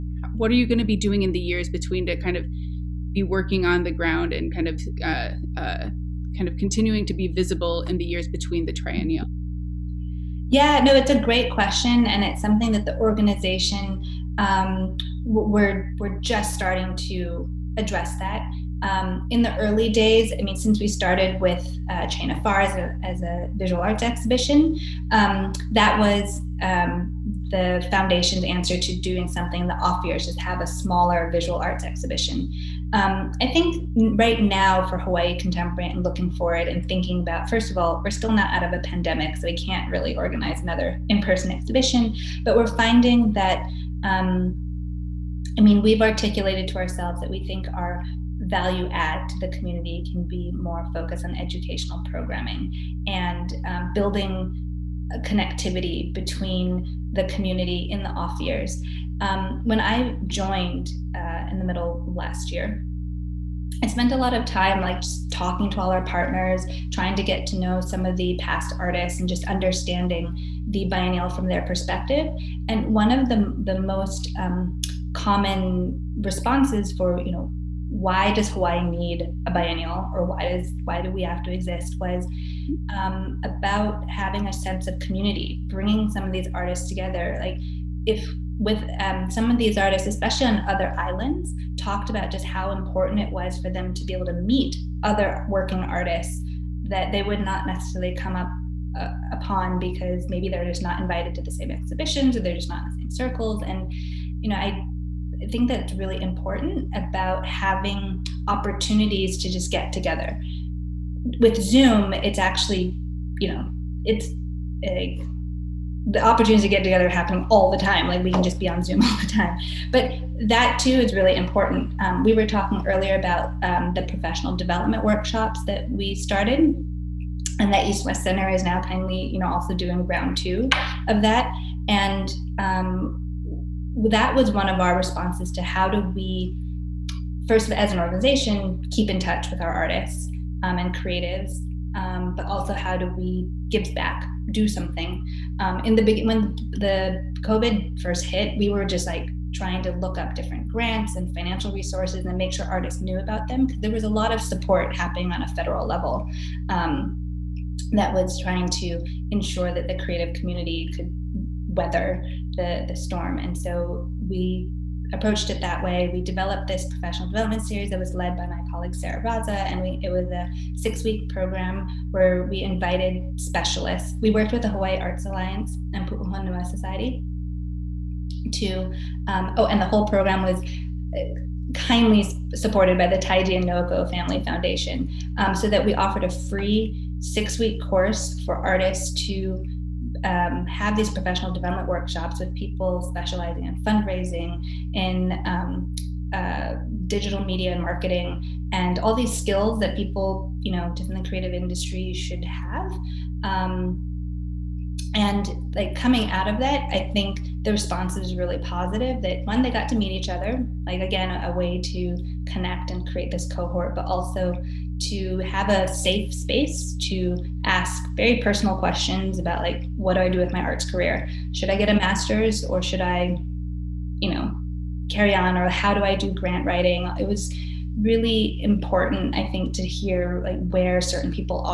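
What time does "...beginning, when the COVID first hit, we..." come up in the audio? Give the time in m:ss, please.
2:26.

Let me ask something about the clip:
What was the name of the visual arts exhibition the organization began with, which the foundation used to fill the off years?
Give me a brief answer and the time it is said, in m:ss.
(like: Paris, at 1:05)
Chain of Fire, at 0:22.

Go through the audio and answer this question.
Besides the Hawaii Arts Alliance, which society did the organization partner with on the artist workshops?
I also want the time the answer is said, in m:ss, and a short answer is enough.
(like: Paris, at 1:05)
Pu'uhonua Society, at 2:56.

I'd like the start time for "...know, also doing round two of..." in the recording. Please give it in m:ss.
2:09.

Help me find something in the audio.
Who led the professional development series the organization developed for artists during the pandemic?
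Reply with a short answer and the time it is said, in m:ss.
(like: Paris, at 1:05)
Sarah Raza, at 2:48.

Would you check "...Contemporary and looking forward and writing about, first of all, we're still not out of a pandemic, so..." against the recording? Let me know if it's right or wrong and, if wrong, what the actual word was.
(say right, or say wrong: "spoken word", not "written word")
wrong: "thinking", not "writing".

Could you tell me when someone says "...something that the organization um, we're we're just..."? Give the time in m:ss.
0:12.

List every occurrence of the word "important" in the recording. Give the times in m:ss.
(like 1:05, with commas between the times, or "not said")
1:32, 1:46, 2:01, 3:48.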